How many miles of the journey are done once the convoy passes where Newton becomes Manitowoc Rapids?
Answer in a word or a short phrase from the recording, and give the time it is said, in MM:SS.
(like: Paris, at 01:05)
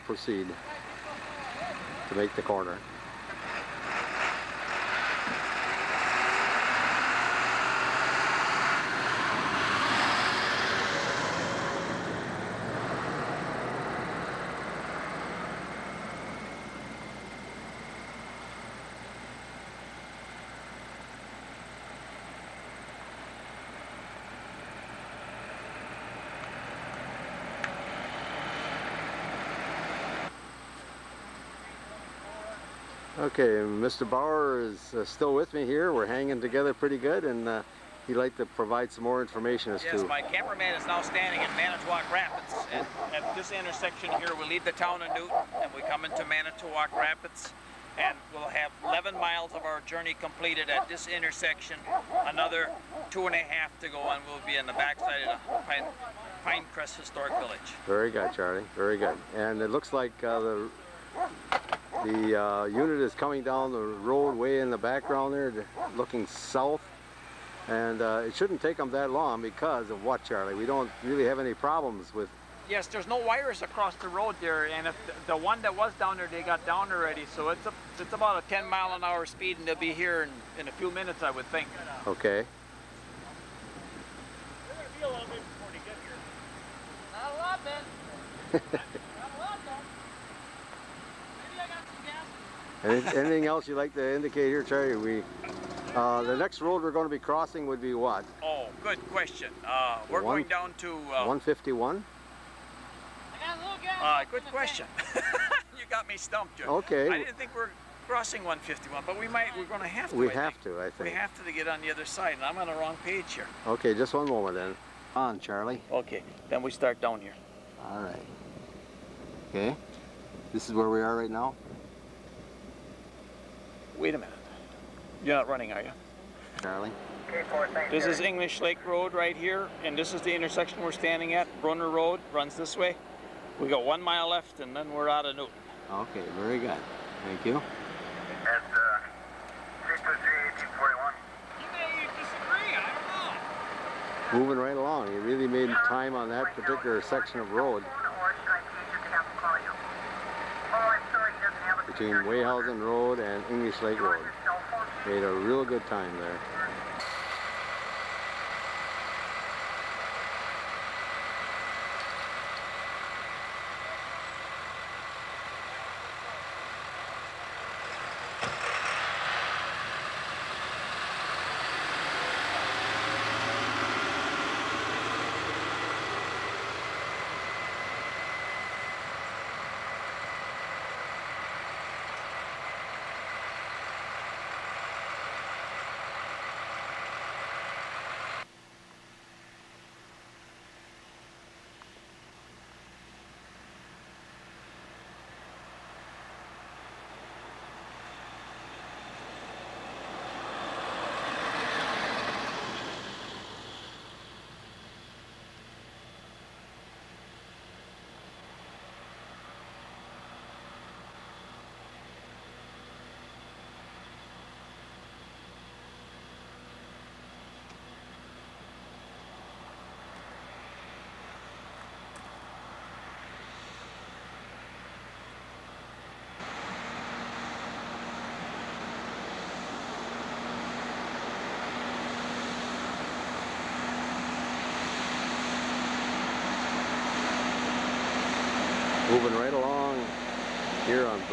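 11, at 00:48.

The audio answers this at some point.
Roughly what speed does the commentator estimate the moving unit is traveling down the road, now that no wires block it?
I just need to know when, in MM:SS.
01:18.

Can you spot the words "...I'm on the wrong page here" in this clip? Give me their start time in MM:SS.
01:52.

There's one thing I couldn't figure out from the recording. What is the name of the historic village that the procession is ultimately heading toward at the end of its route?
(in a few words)
Pinecrest Historic Village.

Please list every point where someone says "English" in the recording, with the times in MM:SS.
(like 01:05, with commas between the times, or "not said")
02:08, 02:33.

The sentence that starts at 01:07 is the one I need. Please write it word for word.
And uh, it shouldn't take them that long because of what, Charlie?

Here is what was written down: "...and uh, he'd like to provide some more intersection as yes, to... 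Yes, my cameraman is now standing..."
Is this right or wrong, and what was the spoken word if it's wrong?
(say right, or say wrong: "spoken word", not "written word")
wrong: "information", not "intersection".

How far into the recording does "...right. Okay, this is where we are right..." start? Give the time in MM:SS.
01:58.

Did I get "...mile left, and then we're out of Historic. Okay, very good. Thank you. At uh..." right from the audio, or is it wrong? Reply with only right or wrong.
wrong.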